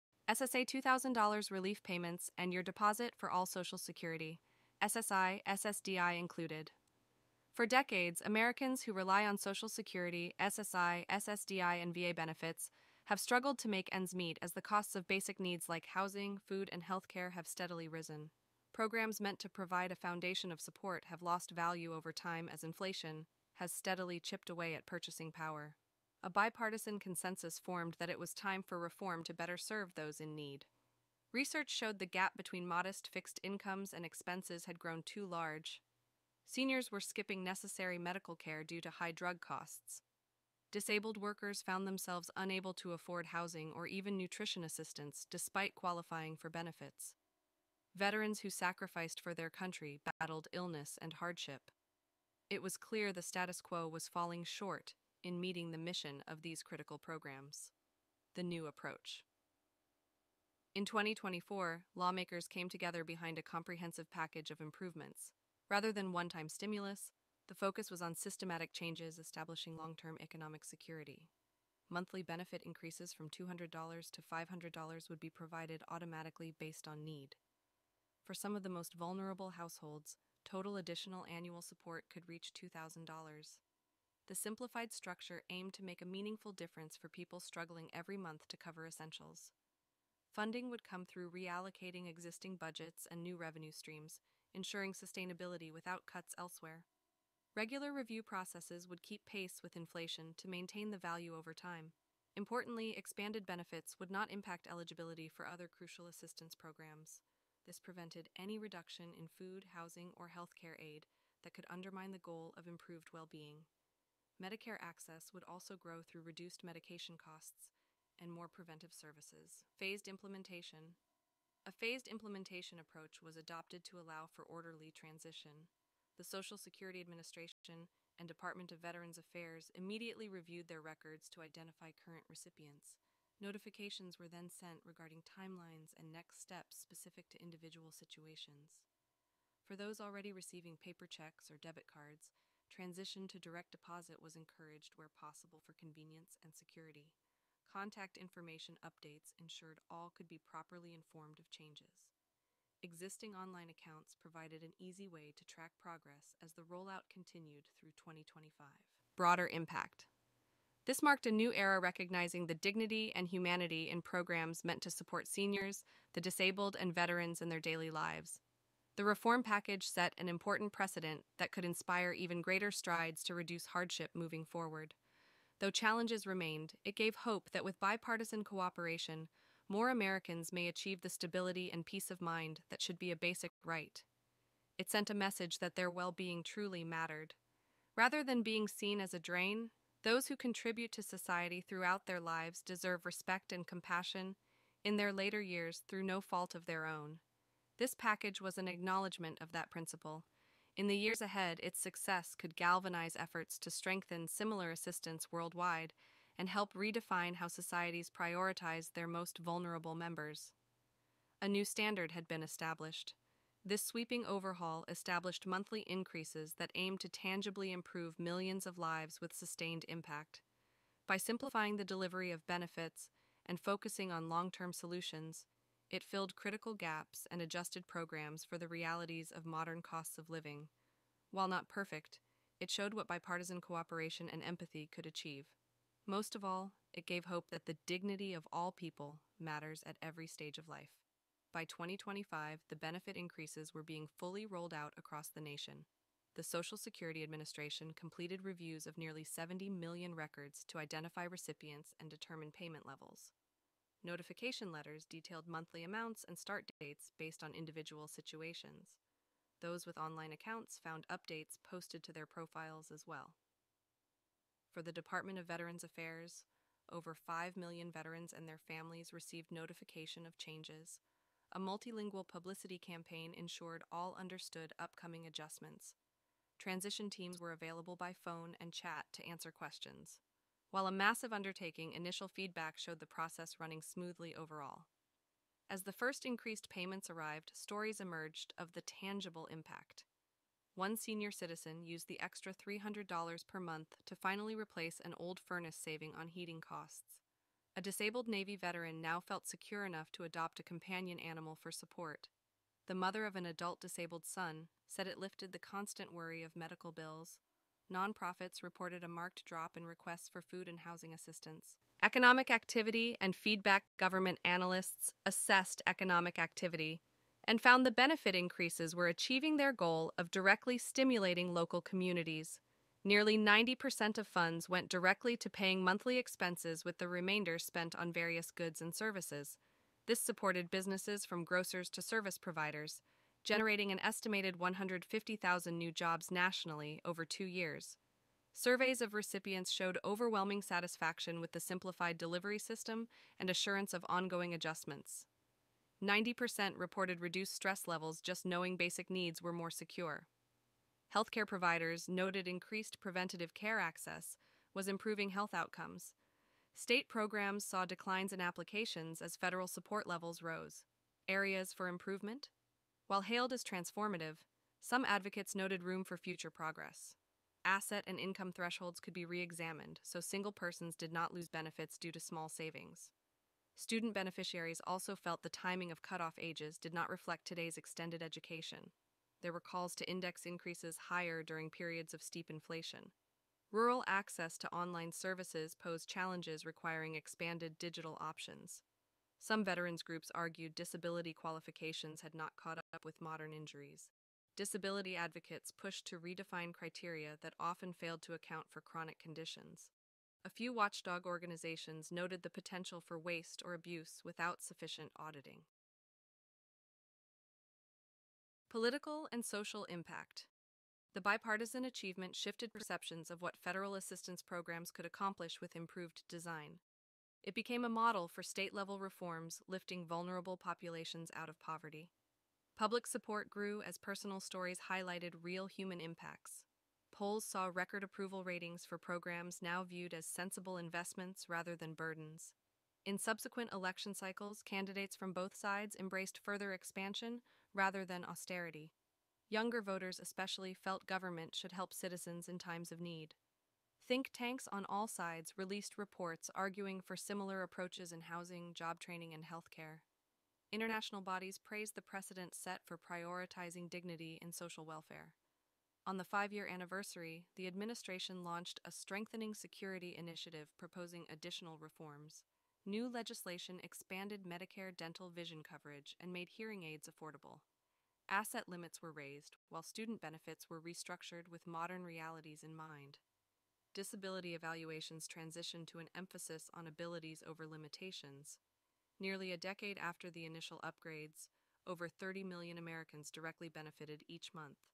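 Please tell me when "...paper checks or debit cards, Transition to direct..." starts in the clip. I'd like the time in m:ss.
2:20.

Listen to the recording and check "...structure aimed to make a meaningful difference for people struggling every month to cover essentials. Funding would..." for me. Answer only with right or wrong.
right.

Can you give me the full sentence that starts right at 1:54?
Medicare access would also grow through reduced medication costs and more preventive services.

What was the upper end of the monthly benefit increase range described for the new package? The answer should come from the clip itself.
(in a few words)
$500.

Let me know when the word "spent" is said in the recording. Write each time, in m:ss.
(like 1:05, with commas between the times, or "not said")
5:27.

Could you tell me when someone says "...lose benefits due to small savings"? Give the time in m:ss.
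6:11.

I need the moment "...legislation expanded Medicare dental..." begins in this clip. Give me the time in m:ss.
7:43.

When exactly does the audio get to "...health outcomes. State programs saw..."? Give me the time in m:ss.
5:55.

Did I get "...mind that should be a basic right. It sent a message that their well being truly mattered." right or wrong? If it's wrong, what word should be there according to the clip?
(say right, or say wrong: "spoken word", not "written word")
right.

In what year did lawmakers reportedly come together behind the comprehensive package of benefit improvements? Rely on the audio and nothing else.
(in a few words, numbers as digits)
2024.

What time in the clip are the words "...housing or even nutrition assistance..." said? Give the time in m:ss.
0:43.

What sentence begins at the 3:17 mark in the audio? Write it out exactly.
This package was an acknowledgement of that principle.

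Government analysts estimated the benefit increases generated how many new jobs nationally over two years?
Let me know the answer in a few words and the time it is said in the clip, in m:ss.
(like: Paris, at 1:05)
150,000, at 5:34.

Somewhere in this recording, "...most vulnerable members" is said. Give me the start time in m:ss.
3:29.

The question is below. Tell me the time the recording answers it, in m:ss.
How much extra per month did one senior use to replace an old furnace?
4:52.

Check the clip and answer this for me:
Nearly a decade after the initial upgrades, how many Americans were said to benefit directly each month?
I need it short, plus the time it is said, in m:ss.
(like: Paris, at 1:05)
Over 30 million, at 8:01.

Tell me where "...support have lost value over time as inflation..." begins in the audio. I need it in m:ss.
0:20.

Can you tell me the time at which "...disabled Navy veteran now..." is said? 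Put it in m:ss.
4:57.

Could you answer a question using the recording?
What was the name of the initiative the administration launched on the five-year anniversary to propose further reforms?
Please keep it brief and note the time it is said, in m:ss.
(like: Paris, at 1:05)
Strengthening Security Initiative, at 7:38.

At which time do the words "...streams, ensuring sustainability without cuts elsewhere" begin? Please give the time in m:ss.
1:33.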